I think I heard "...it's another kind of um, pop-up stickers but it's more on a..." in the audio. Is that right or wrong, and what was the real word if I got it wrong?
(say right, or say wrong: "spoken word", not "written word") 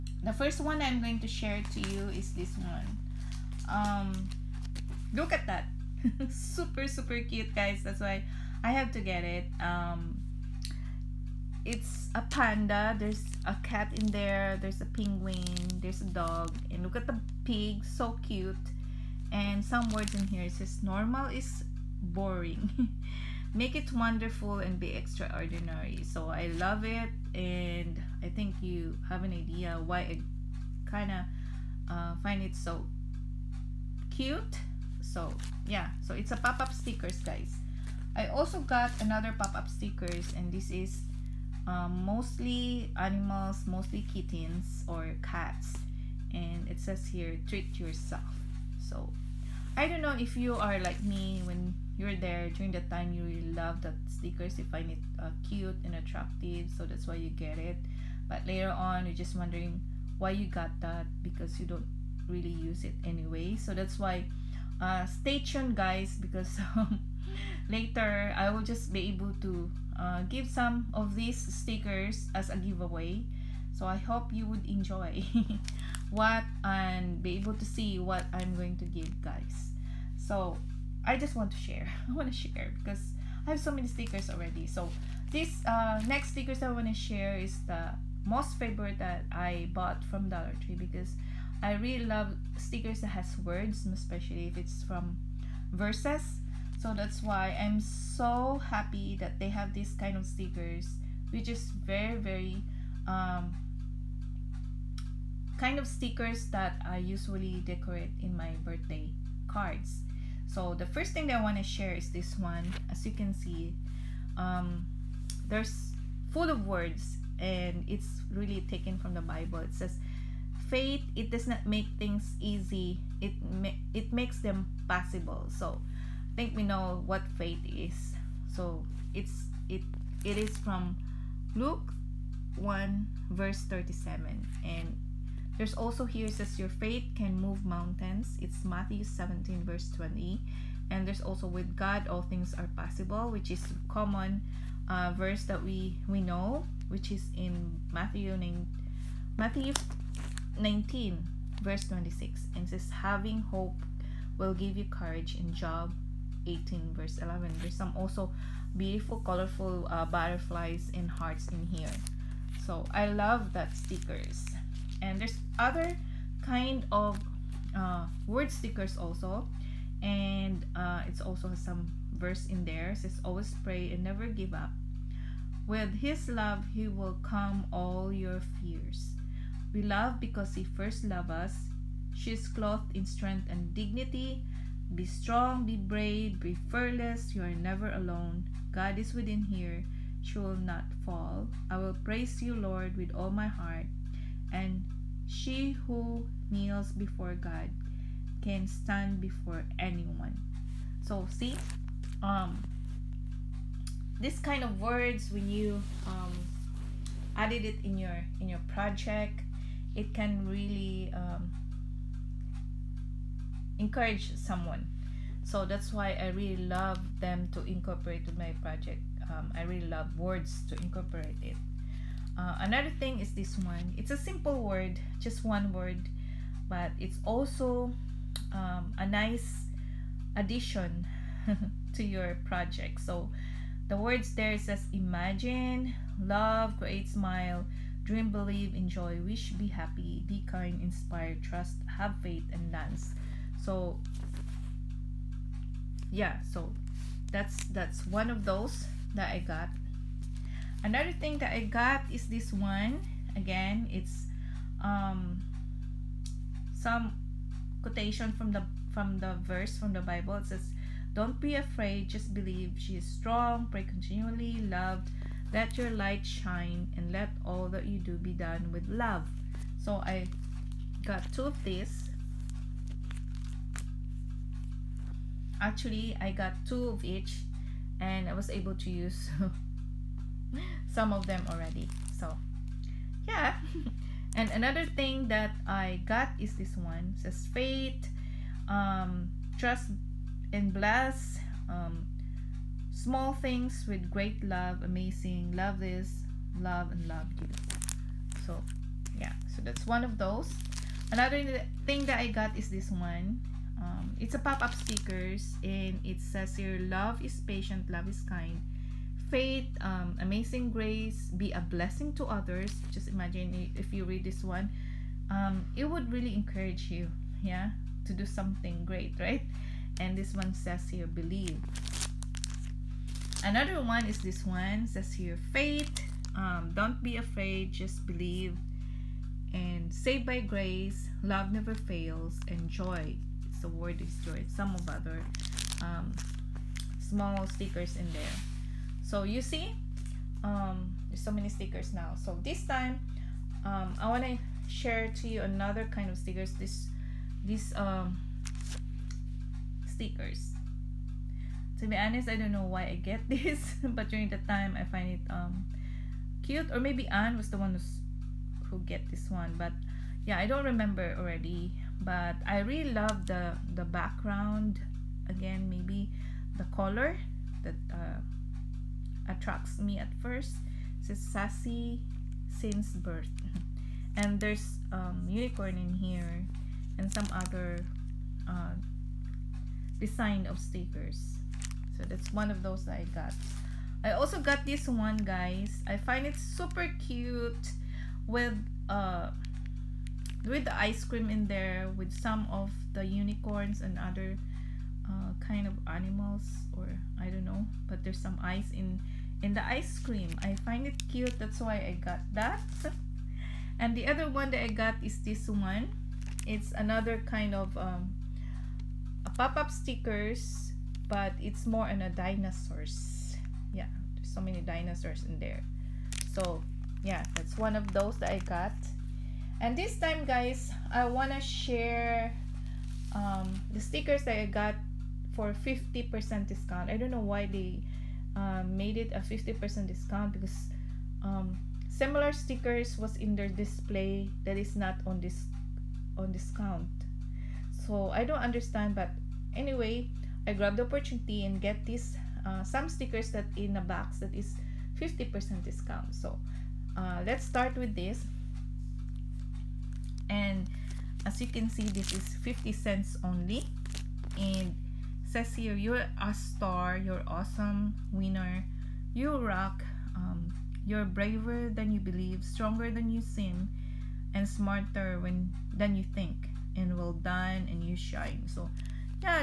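right.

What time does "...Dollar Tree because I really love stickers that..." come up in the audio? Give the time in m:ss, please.
1:30.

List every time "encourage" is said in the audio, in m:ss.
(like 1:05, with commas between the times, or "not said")
3:33, 5:16.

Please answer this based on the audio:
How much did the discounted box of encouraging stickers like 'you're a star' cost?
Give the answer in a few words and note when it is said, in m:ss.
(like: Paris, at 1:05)
50 cents, at 7:32.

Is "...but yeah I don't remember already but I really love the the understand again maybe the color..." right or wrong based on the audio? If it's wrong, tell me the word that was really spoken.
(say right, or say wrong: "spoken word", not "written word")
wrong: "background", not "understand".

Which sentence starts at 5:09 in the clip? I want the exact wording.
Faith, um, amazing grace, be a blessing to others.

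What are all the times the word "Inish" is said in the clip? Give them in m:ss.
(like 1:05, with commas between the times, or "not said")
not said.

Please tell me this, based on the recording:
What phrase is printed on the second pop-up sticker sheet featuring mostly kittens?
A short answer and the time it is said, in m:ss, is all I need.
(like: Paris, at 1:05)
Treat yourself, at 0:47.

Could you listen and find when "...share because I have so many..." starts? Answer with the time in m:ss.
1:22.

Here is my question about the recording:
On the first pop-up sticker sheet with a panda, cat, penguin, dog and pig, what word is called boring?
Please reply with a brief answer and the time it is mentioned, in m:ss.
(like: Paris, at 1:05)
Normal, at 0:20.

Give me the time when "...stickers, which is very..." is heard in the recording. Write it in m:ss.
1:40.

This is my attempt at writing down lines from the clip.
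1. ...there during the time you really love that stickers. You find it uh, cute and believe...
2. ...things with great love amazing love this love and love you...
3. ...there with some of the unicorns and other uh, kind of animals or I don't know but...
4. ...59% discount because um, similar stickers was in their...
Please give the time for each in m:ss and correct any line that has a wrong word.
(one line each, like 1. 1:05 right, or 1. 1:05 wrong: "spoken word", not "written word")
1. 0:52 wrong: "attractive", not "believe"
2. 4:53 right
3. 6:31 right
4. 7:09 wrong: "50", not "59".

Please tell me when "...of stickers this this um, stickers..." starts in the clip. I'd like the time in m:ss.
5:46.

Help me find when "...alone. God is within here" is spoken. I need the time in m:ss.
3:07.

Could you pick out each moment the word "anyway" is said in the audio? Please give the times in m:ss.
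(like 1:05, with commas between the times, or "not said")
1:03, 7:19.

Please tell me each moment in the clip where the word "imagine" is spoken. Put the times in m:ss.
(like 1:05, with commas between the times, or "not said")
3:54, 5:13.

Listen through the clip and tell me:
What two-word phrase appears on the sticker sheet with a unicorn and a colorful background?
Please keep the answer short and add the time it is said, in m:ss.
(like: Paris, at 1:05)
Sassy since birth, at 6:11.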